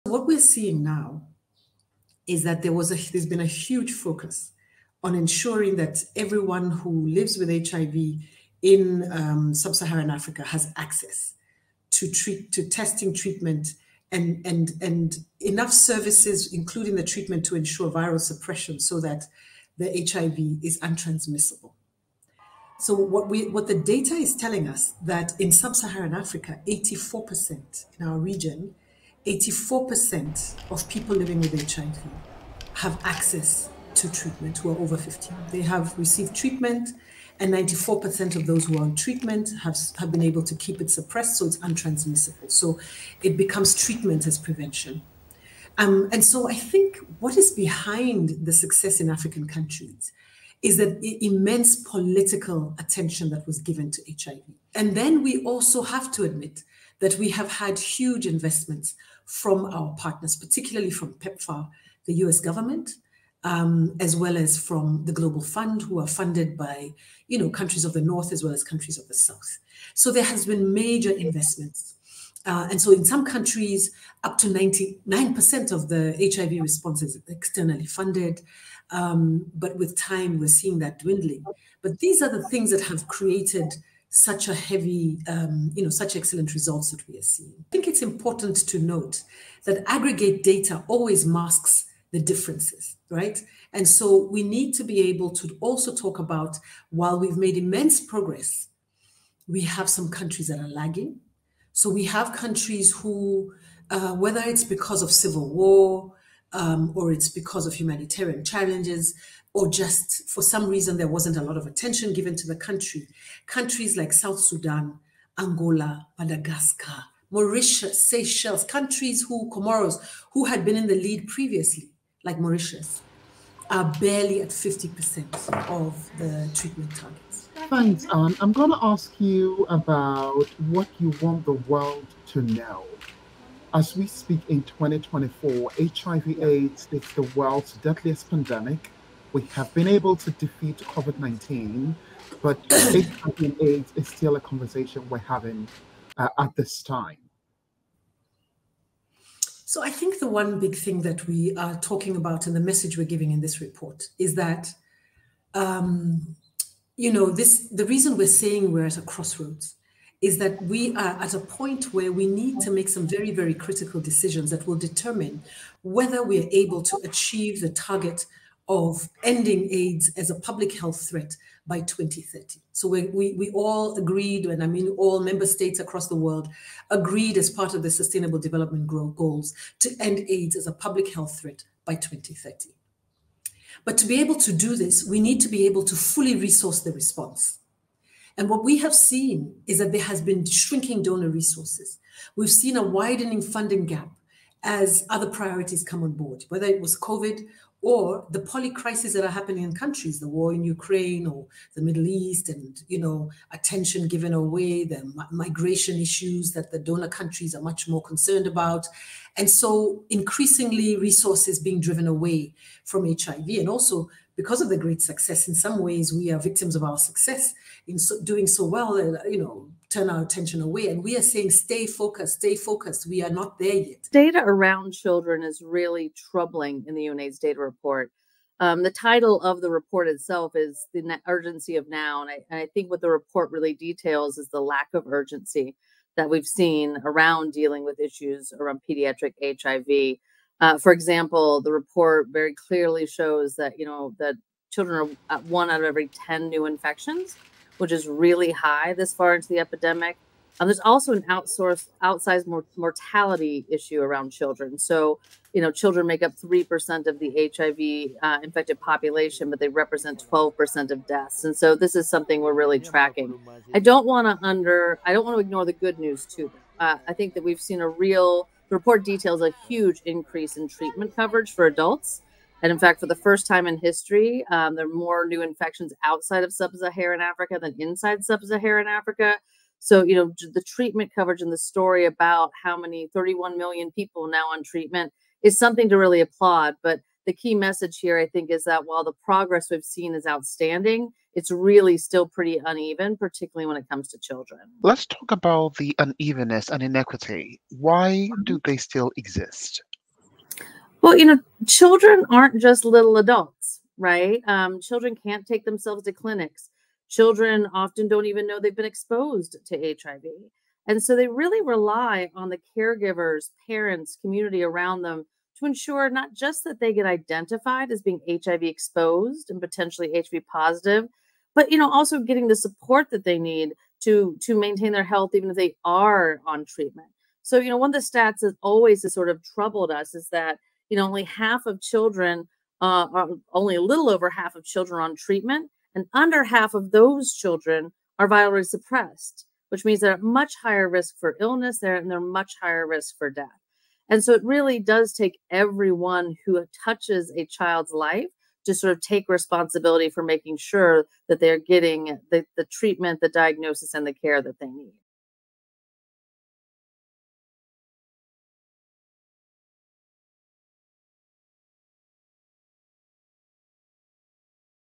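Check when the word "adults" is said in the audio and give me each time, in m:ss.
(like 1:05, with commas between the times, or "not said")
4:31, 5:03.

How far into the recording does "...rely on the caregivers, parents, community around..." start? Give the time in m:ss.
5:11.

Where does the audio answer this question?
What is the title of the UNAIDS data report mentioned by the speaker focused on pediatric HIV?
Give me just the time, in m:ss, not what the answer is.
3:50.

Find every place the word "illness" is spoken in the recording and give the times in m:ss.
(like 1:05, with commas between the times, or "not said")
5:41.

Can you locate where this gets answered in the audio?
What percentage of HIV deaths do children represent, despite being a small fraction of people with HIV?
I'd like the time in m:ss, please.
4:20.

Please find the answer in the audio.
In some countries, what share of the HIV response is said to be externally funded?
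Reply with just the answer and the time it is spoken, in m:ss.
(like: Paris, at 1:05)
99%, at 1:14.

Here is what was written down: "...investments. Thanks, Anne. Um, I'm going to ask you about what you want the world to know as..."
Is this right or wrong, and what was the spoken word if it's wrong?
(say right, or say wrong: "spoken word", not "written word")
wrong: "targets", not "investments".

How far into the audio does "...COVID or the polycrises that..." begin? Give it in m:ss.
3:16.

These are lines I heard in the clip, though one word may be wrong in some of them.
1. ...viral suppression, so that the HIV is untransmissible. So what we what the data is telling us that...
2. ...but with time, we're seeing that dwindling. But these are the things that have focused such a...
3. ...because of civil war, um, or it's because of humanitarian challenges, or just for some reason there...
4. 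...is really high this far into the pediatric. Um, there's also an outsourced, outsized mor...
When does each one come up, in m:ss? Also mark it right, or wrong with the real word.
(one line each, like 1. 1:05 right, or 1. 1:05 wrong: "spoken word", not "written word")
1. 0:17 right
2. 1:19 wrong: "created", not "focused"
3. 1:44 right
4. 4:07 wrong: "epidemic", not "pediatric".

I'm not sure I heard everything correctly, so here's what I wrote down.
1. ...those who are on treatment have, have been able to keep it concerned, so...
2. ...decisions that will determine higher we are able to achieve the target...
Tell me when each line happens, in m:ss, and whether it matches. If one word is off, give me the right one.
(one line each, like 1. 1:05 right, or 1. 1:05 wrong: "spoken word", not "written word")
1. 0:38 wrong: "suppressed", not "concerned"
2. 2:43 wrong: "whether", not "higher".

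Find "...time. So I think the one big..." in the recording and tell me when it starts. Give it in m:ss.
2:26.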